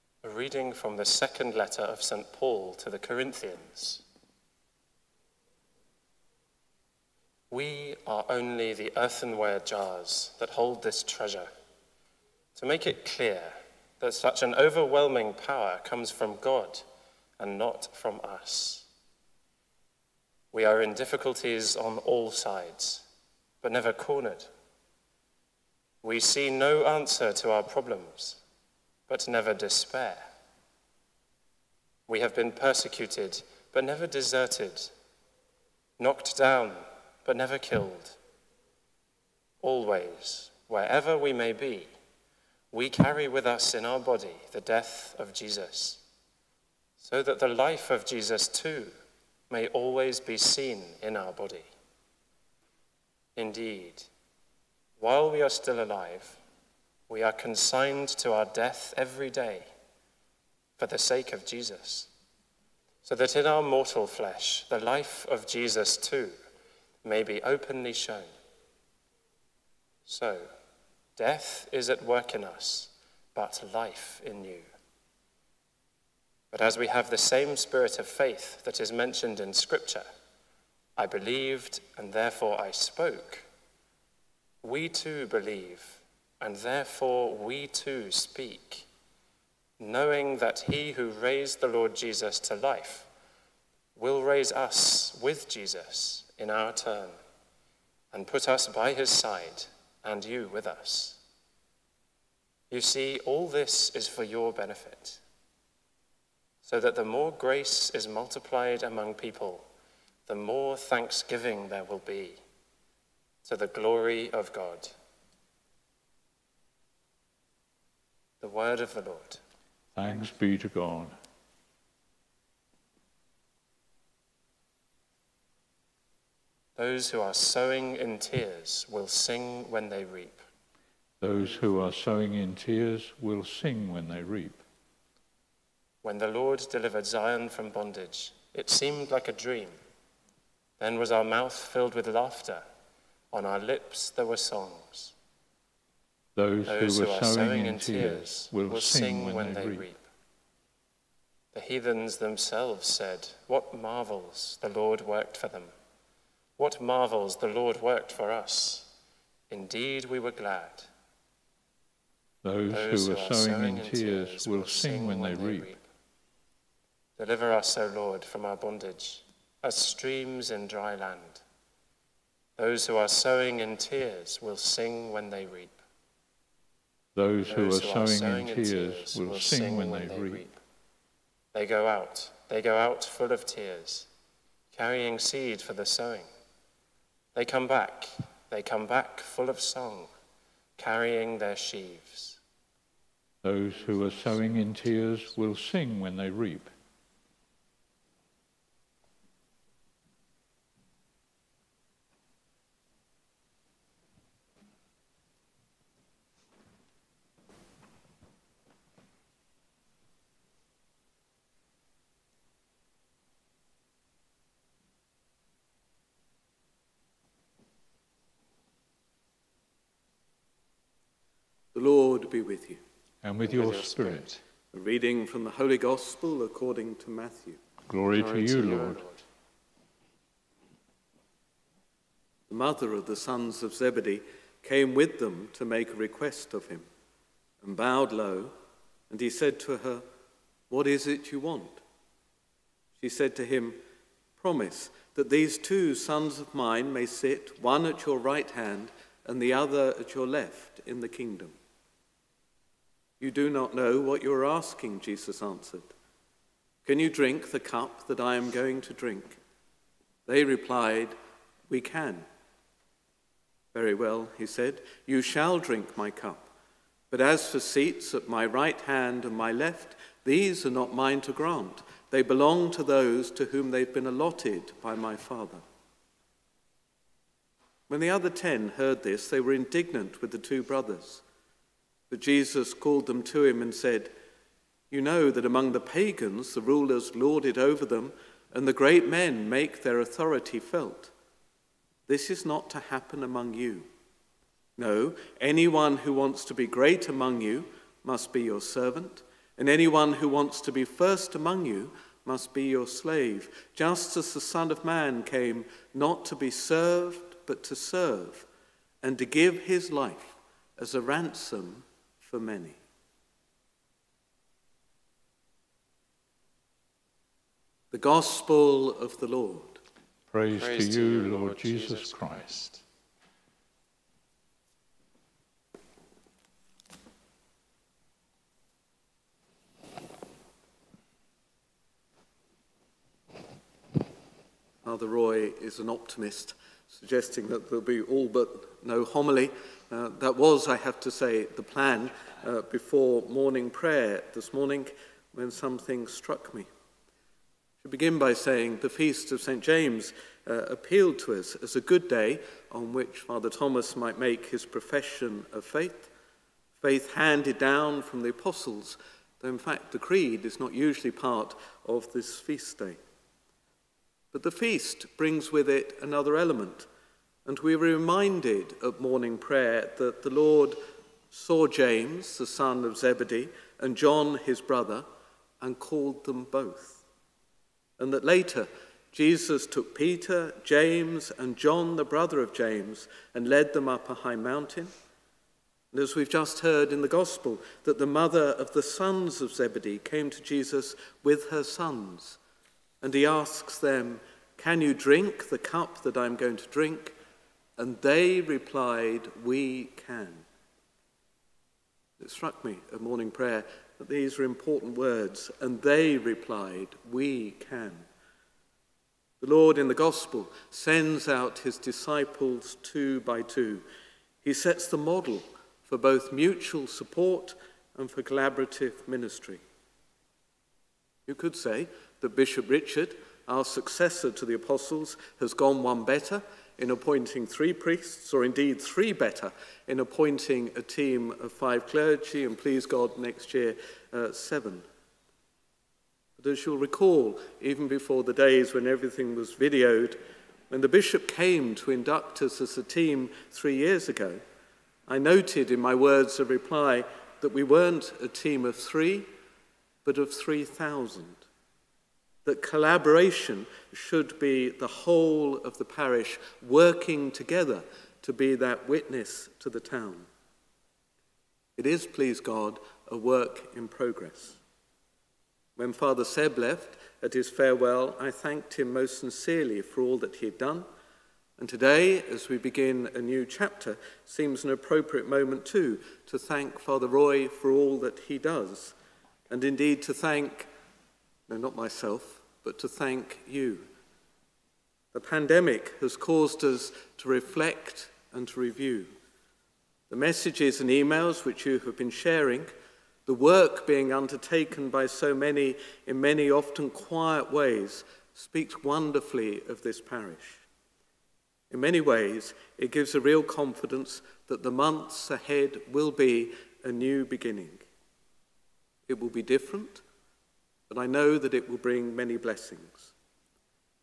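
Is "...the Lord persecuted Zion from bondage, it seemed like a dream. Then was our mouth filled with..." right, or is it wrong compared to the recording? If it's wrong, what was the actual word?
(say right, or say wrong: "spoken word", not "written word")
wrong: "delivered", not "persecuted".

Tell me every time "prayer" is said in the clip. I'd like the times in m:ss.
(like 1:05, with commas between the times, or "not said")
5:43, 6:09, 6:43.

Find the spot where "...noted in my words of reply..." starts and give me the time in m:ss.
7:25.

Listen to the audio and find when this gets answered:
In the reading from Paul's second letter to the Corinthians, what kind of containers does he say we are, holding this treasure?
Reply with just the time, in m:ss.
0:08.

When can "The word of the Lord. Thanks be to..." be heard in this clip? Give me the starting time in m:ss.
1:58.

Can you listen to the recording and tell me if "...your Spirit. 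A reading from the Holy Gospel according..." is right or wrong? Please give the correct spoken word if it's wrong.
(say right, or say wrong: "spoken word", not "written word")
right.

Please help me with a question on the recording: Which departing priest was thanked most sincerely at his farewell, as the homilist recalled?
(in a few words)
Father Seb.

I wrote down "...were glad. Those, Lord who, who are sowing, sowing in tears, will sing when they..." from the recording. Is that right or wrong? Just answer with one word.
wrong.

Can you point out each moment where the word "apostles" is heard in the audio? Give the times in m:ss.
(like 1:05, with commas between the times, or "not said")
5:58, 7:04.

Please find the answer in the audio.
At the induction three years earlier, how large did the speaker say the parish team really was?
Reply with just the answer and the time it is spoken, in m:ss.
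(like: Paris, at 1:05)
3,000, at 7:30.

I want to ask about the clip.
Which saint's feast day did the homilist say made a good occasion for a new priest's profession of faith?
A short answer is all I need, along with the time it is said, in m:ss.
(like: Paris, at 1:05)
St. James, at 5:48.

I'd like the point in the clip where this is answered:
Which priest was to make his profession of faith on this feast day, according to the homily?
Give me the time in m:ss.
5:53.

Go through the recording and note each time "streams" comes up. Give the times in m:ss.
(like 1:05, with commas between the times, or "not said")
2:49.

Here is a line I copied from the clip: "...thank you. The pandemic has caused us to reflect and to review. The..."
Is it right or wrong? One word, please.
right.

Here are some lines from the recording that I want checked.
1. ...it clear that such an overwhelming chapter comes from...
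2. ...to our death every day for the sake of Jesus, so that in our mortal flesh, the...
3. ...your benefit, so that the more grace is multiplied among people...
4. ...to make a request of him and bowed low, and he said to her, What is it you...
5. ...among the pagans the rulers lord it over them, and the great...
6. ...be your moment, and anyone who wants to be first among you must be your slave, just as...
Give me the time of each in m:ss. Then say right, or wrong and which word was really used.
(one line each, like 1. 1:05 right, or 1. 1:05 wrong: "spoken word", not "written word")
1. 0:12 wrong: "power", not "chapter"
2. 0:58 right
3. 1:44 right
4. 3:55 right
5. 4:45 right
6. 4:58 wrong: "servant", not "moment".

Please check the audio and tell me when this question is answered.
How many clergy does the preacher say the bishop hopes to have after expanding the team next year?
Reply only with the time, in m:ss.
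7:14.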